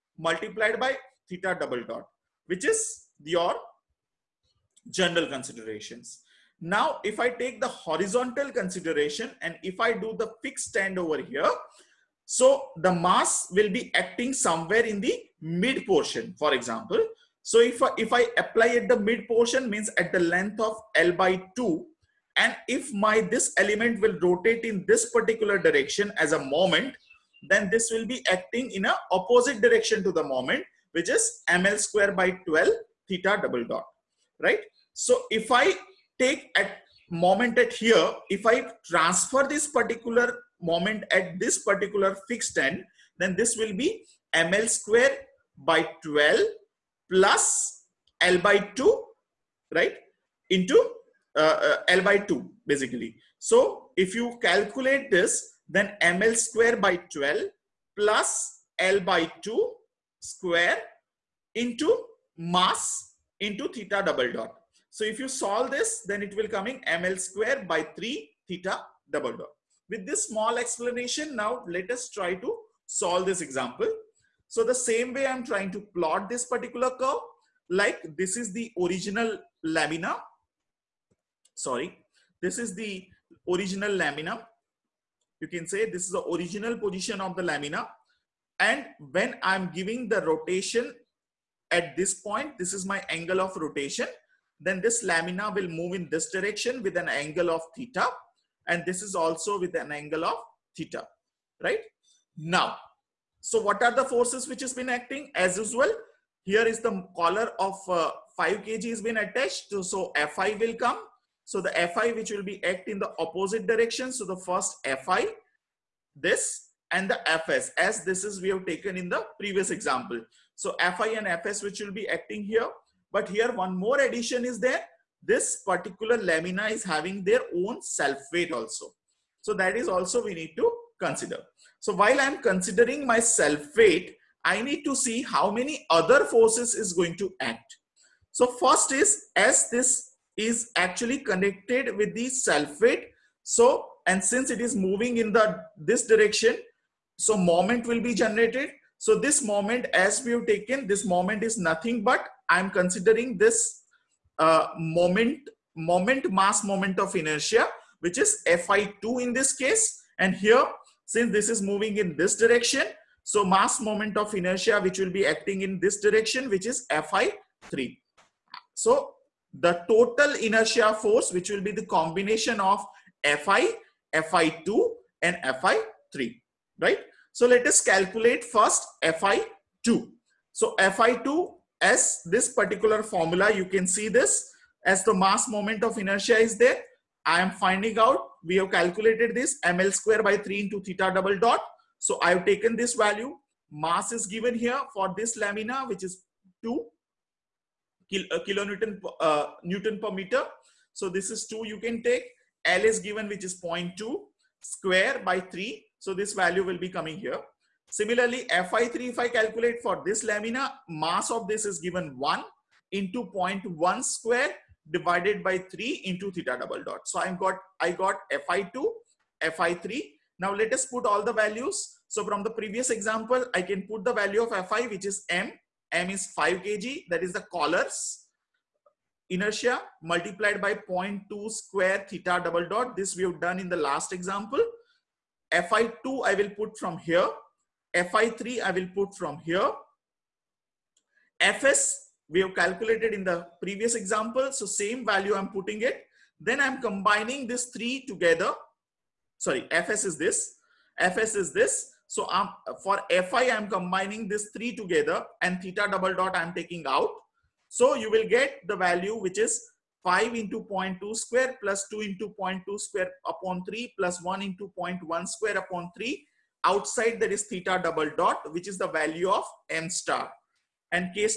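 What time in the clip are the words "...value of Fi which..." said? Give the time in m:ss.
3:44.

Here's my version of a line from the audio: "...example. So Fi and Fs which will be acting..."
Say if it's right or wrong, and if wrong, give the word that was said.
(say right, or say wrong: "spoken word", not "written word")
right.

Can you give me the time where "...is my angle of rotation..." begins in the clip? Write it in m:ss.
1:32.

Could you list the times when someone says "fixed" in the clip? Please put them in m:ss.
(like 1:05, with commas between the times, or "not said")
0:10, 0:42.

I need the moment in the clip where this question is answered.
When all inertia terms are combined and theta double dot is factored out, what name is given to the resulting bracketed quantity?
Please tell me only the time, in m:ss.
4:29.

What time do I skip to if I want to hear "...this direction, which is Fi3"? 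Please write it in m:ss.
2:45.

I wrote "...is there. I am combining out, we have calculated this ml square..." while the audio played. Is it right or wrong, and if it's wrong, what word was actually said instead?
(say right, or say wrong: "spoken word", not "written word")
wrong: "finding", not "combining".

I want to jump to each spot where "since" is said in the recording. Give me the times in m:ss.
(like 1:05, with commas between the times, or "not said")
2:24, 2:41.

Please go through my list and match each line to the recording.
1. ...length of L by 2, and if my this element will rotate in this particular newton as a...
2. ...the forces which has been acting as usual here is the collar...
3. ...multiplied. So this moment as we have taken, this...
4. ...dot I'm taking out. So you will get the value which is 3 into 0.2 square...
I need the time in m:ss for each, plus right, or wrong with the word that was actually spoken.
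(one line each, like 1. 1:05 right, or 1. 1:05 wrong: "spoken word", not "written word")
1. 0:20 wrong: "direction", not "newton"
2. 1:43 right
3. 2:28 wrong: "generated", not "multiplied"
4. 4:16 wrong: "5", not "3".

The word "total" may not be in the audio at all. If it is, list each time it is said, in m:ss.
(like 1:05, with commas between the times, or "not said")
2:49.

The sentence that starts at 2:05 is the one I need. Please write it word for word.
This particular lamina is having their own self weight also.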